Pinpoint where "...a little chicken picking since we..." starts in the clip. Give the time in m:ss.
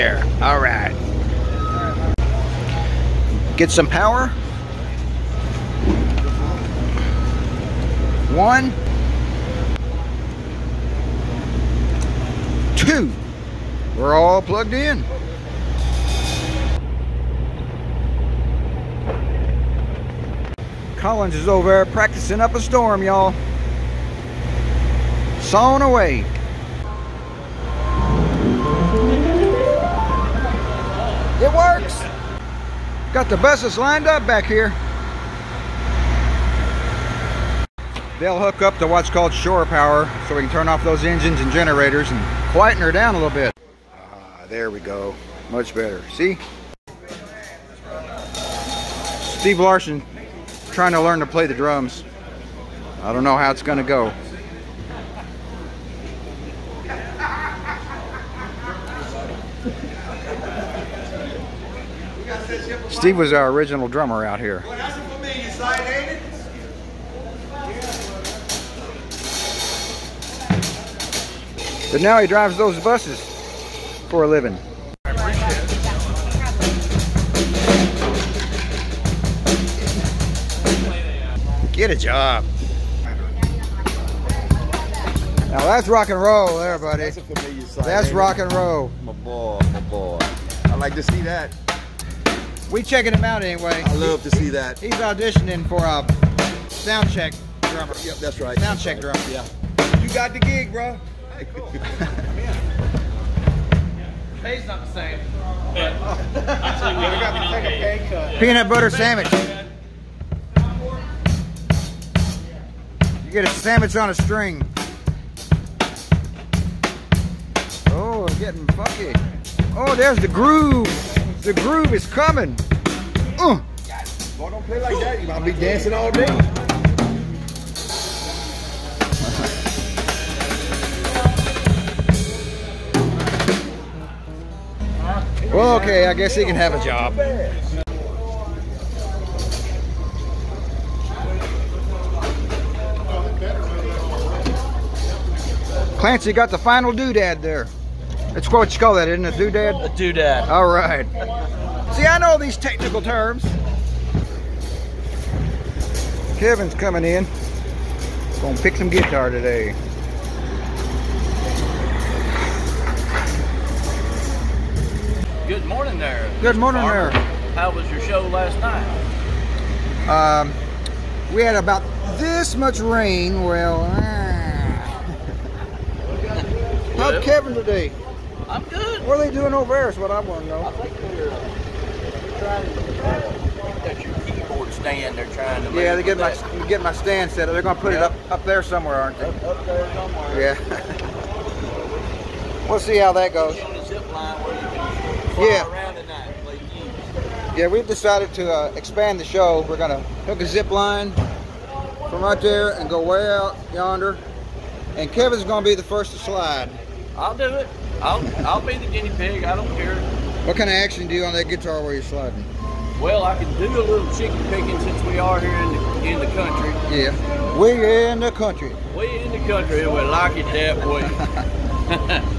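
3:33.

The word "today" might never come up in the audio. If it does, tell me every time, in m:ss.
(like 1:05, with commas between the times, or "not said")
2:39, 2:57.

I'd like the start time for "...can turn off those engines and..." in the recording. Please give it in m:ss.
0:40.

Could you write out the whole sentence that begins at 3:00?
I think they're trying uh, to...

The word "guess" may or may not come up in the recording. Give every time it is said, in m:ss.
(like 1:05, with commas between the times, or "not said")
2:16.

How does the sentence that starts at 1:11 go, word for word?
But now he drives those buses for a living.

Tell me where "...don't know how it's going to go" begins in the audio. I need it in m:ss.
0:53.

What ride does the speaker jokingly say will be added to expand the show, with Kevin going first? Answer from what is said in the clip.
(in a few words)
zip line.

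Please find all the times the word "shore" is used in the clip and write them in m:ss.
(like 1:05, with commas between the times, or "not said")
0:39.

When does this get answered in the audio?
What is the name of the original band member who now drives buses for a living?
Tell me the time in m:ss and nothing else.
0:49.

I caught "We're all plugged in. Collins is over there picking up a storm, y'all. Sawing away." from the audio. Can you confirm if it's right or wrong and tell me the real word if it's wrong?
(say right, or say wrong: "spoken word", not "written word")
wrong: "practicing", not "picking".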